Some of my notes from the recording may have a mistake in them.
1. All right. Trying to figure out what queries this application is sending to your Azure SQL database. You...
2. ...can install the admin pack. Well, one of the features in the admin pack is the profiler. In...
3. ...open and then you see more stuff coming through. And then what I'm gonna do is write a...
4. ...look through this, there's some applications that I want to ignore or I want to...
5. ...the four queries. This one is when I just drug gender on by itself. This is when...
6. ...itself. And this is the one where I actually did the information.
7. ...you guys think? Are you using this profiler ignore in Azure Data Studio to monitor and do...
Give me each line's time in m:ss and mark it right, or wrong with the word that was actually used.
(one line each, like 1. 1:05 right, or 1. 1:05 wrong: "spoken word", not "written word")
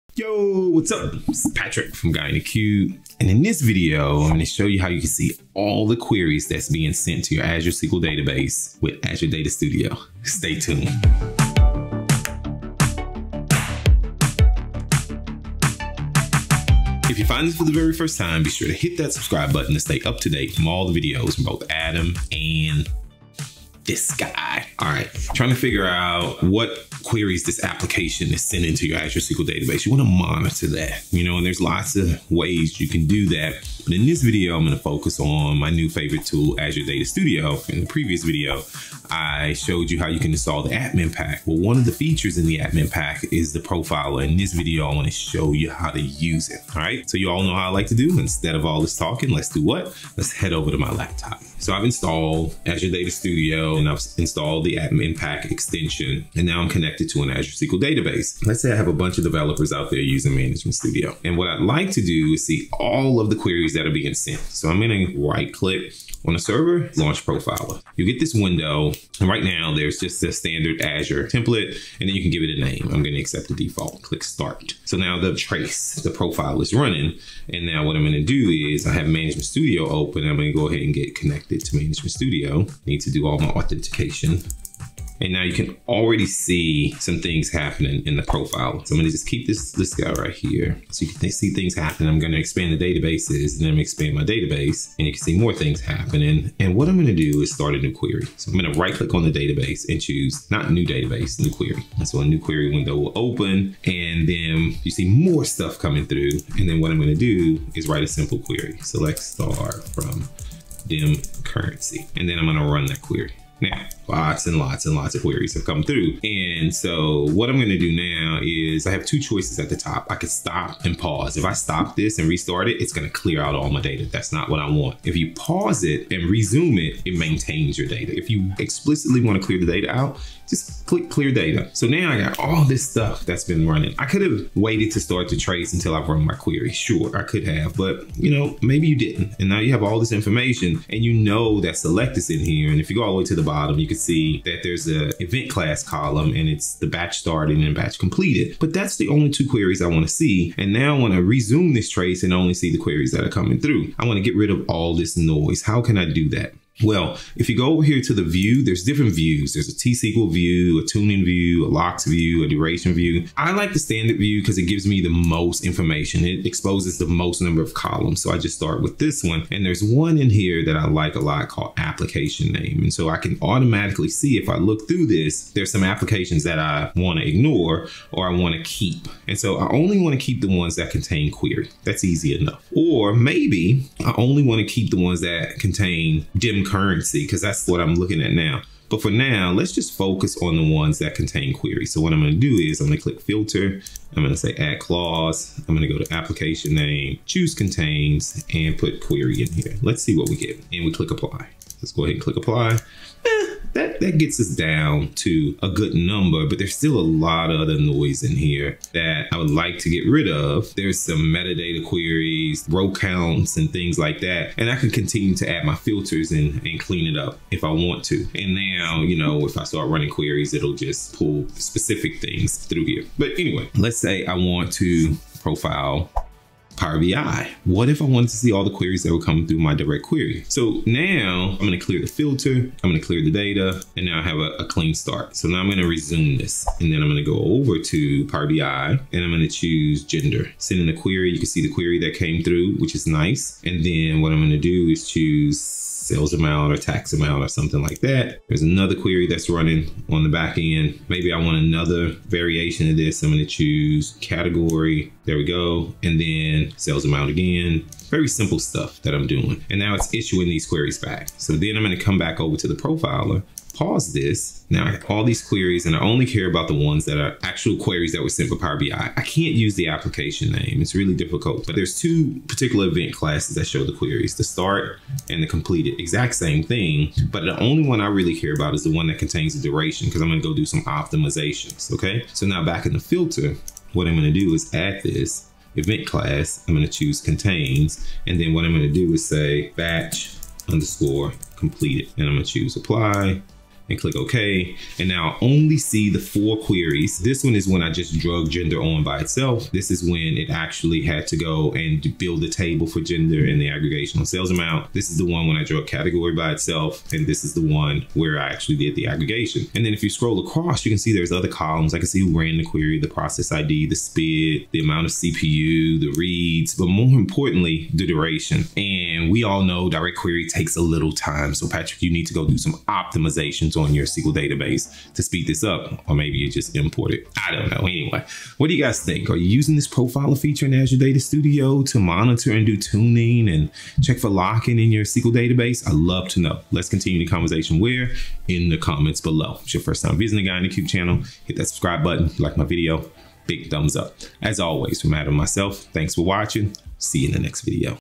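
1. 0:24 right
2. 0:40 right
3. 1:43 right
4. 2:54 right
5. 4:56 right
6. 5:06 wrong: "aggregation", not "information"
7. 5:28 wrong: "feature", not "ignore".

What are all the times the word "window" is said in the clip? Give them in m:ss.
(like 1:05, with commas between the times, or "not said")
1:08, 1:42.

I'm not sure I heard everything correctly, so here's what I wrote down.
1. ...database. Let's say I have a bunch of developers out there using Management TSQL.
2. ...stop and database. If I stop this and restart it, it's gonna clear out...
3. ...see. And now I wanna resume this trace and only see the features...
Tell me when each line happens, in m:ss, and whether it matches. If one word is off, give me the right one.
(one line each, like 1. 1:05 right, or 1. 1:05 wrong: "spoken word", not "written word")
1. 0:57 wrong: "Studio", not "TSQL"
2. 2:00 wrong: "pause", not "database"
3. 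2:30 wrong: "queries", not "features".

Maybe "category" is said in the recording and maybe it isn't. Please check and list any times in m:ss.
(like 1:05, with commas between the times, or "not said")
4:14, 5:05.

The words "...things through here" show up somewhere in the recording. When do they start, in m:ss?
3:42.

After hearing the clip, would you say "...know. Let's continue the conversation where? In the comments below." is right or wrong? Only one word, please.
right.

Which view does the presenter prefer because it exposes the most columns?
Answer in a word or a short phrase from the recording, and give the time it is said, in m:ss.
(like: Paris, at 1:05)
standard view, at 2:43.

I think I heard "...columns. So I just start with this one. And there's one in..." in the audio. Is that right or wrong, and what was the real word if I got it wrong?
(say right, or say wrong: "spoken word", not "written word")
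right.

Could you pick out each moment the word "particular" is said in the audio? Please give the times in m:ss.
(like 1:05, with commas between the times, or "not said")
4:32.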